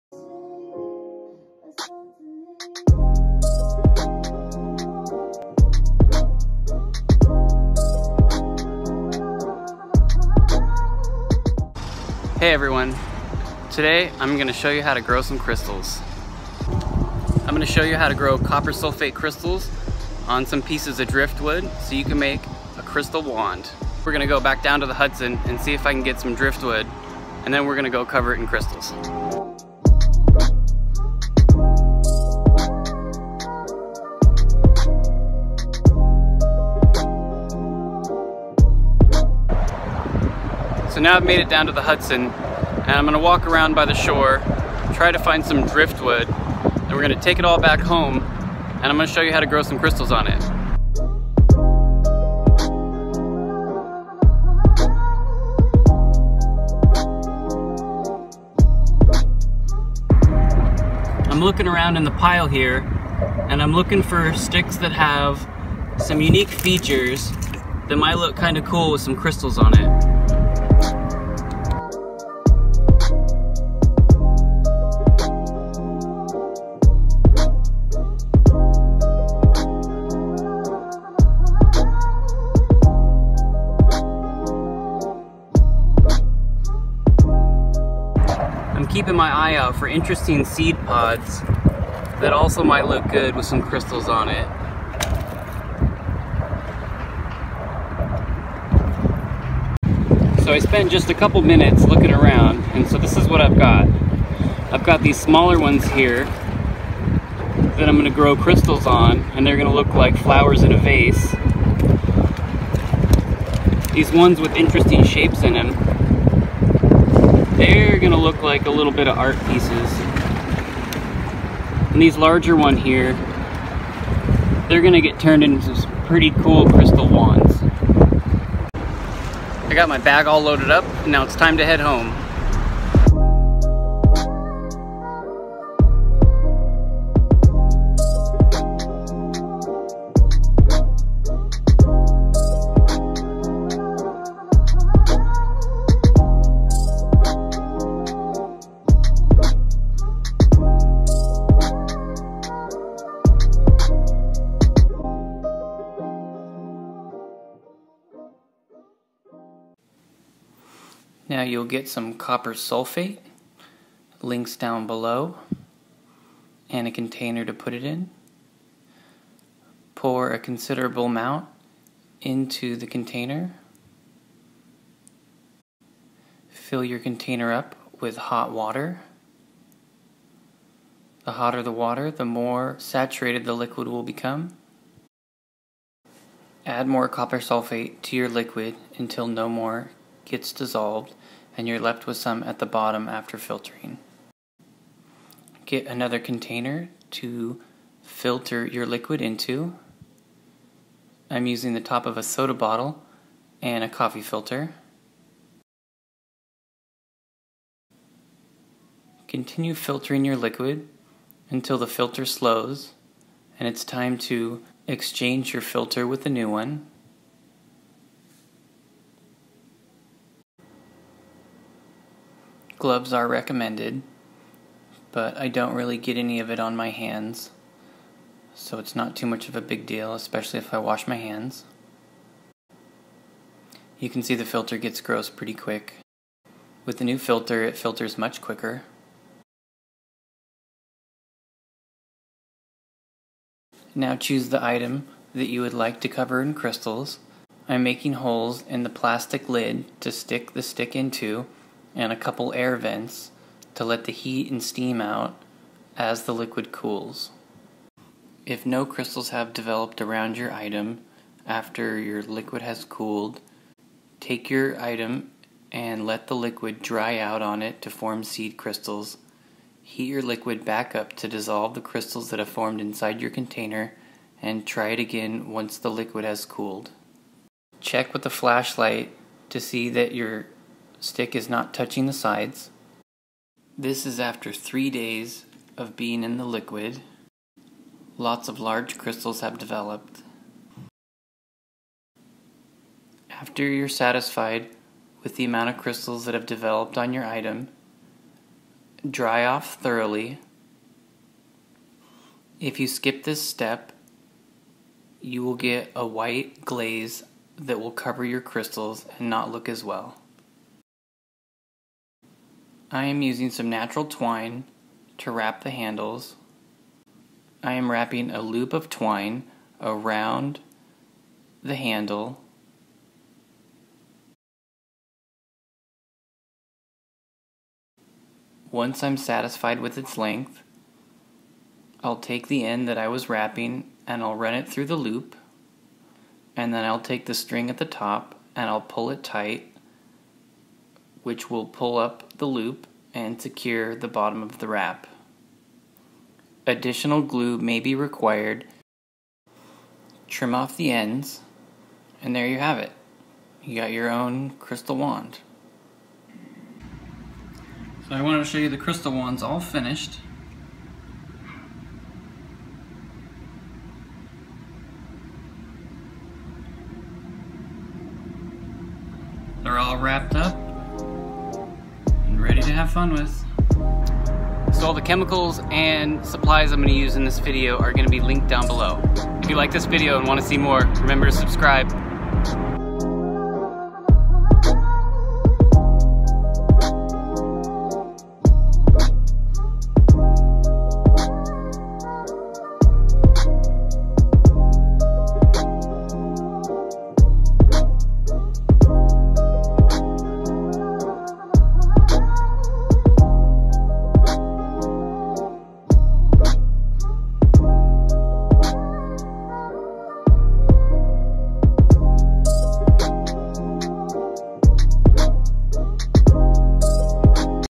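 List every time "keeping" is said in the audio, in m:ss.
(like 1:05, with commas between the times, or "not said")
1:29.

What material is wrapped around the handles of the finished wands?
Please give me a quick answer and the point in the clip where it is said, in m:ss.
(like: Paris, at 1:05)
natural twine, at 5:13.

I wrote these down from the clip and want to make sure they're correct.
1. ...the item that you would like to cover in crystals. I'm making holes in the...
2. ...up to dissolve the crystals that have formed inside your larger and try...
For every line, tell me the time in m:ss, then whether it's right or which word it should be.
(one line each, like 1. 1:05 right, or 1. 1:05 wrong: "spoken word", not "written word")
1. 4:04 right
2. 4:30 wrong: "container", not "larger".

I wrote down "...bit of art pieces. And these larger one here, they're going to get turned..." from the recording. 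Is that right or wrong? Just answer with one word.
right.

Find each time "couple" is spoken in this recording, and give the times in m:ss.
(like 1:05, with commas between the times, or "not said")
1:41, 4:12.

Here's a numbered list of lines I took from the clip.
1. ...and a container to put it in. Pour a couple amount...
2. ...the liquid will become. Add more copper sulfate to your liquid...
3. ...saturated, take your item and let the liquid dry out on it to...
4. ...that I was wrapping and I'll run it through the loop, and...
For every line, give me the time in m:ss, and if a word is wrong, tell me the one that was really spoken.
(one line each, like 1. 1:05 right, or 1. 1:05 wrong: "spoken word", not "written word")
1. 2:46 wrong: "considerable", not "couple"
2. 3:03 right
3. 4:22 wrong: "cooled", not "saturated"
4. 5:32 right.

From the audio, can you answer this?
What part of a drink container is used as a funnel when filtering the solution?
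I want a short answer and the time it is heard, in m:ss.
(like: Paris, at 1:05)
top of a soda bottle, at 3:21.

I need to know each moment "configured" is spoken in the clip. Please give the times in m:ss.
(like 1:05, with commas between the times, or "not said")
not said.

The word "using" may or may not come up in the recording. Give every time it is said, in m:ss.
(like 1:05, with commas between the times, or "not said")
3:21, 5:13.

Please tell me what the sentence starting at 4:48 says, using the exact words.
Lots of large crystals have developed.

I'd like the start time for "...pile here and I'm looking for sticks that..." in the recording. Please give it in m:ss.
1:02.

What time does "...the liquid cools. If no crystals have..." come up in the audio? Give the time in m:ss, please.
4:16.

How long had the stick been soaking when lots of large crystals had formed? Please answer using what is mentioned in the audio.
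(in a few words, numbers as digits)
3 days.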